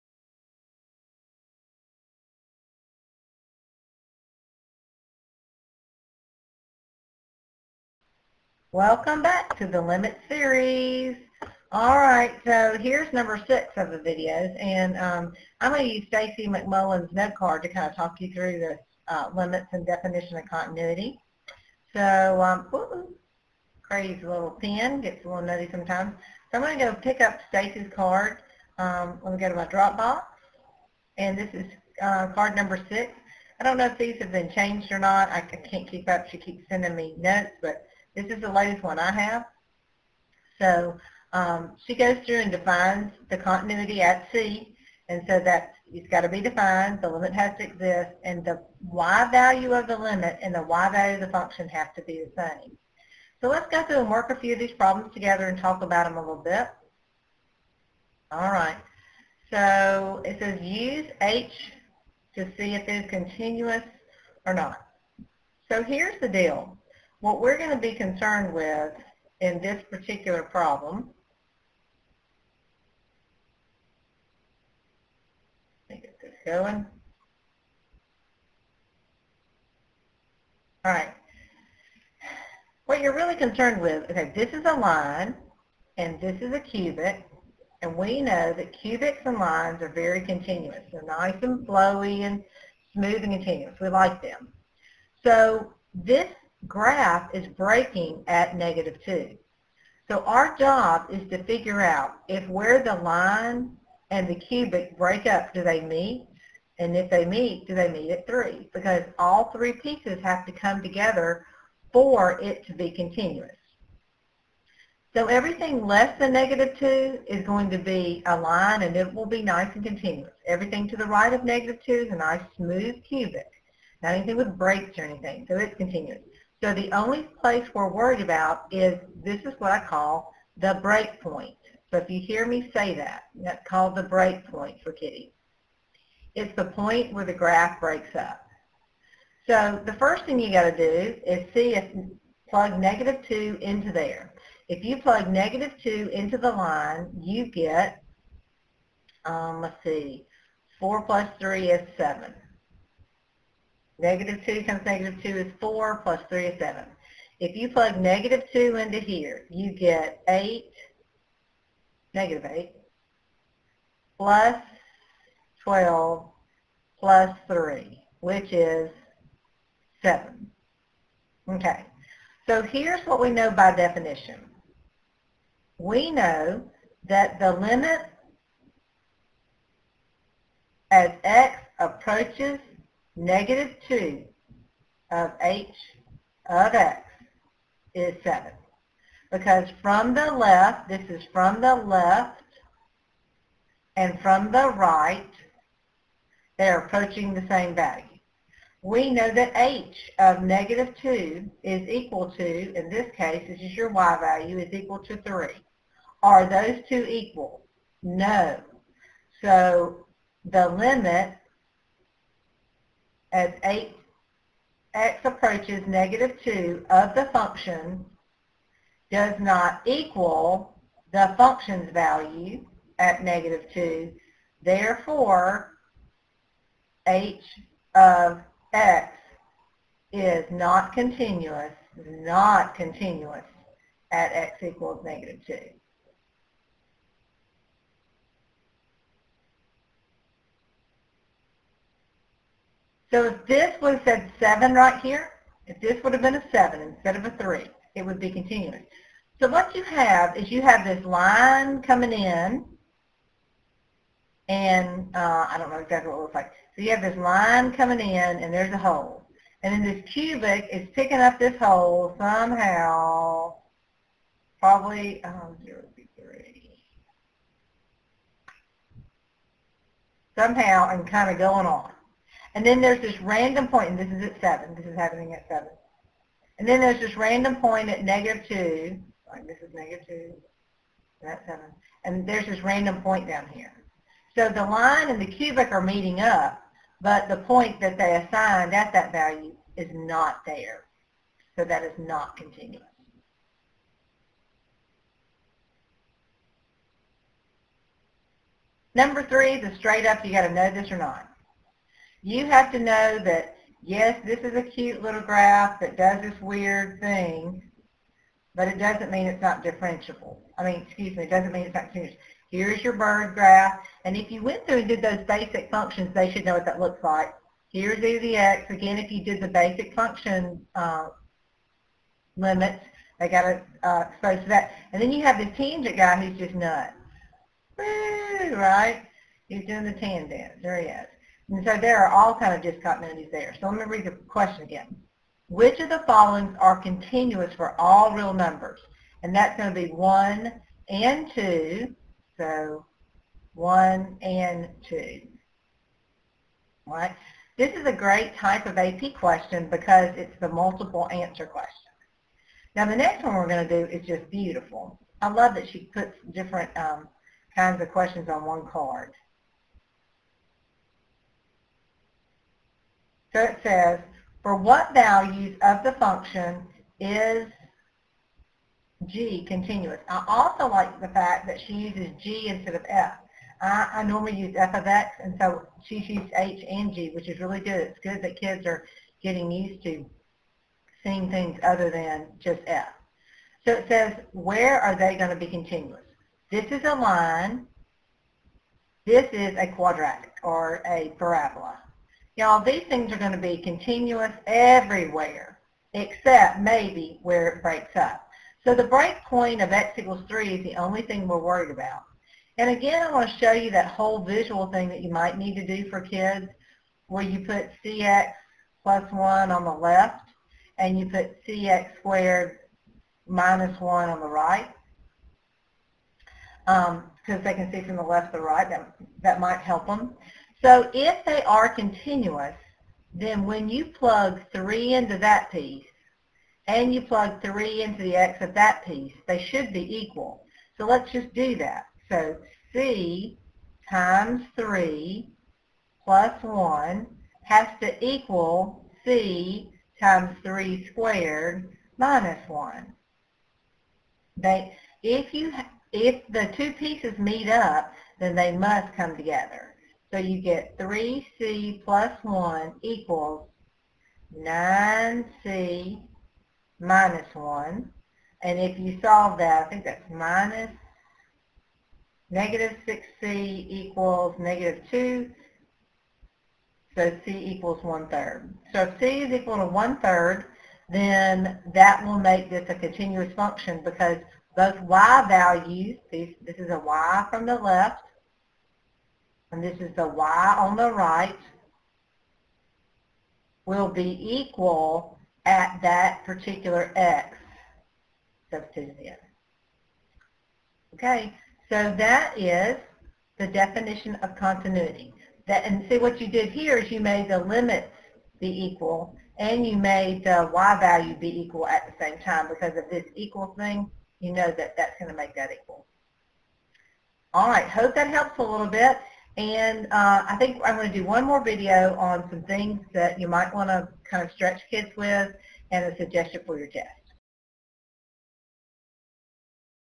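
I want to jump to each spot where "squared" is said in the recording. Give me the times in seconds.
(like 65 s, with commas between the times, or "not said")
411 s, 440 s.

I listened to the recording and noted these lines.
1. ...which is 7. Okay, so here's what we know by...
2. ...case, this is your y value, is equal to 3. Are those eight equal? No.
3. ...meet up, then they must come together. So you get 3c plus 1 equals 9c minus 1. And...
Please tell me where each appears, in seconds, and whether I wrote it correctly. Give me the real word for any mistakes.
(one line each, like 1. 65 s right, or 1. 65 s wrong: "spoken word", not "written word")
1. 168 s right
2. 203 s wrong: "two", not "eight"
3. 447 s right.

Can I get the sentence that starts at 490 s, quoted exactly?
Okay, so that is the definition of continuity.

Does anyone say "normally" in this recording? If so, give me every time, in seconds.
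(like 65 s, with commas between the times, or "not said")
374 s.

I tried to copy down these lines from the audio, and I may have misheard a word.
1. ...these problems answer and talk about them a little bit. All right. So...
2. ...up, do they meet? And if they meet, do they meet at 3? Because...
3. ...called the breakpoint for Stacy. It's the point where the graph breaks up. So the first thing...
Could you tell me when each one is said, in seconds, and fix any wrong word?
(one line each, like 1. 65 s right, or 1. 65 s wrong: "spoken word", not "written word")
1. 54 s wrong: "together", not "answer"
2. 105 s right
3. 133 s wrong: "Kitty", not "Stacy".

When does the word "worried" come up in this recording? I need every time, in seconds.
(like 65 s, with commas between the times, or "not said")
127 s, 401 s.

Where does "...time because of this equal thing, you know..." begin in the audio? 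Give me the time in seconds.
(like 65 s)
502 s.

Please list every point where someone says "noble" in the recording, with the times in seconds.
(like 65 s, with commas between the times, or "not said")
not said.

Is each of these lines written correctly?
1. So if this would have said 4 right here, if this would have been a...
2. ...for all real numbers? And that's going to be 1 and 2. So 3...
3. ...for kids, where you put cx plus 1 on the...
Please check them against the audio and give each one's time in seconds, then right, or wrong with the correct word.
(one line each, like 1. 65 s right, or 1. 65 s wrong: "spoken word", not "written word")
1. 243 s wrong: "7", not "4"
2. 337 s wrong: "1", not "3"
3. 405 s right.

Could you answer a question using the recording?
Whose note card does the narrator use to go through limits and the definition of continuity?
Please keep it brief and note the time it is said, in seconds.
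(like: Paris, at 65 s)
Stacy McMullen, at 16 s.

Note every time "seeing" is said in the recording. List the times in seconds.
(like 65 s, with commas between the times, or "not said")
381 s.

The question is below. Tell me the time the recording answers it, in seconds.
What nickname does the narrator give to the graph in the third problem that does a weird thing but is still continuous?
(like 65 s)
312 s.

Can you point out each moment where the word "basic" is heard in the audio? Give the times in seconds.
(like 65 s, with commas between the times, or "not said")
315 s, 319 s.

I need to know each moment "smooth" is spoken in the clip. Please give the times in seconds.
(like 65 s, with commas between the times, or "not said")
92 s, 122 s.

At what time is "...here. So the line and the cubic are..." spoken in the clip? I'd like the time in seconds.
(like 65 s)
283 s.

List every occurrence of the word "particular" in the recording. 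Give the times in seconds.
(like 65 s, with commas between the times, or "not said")
69 s, 486 s.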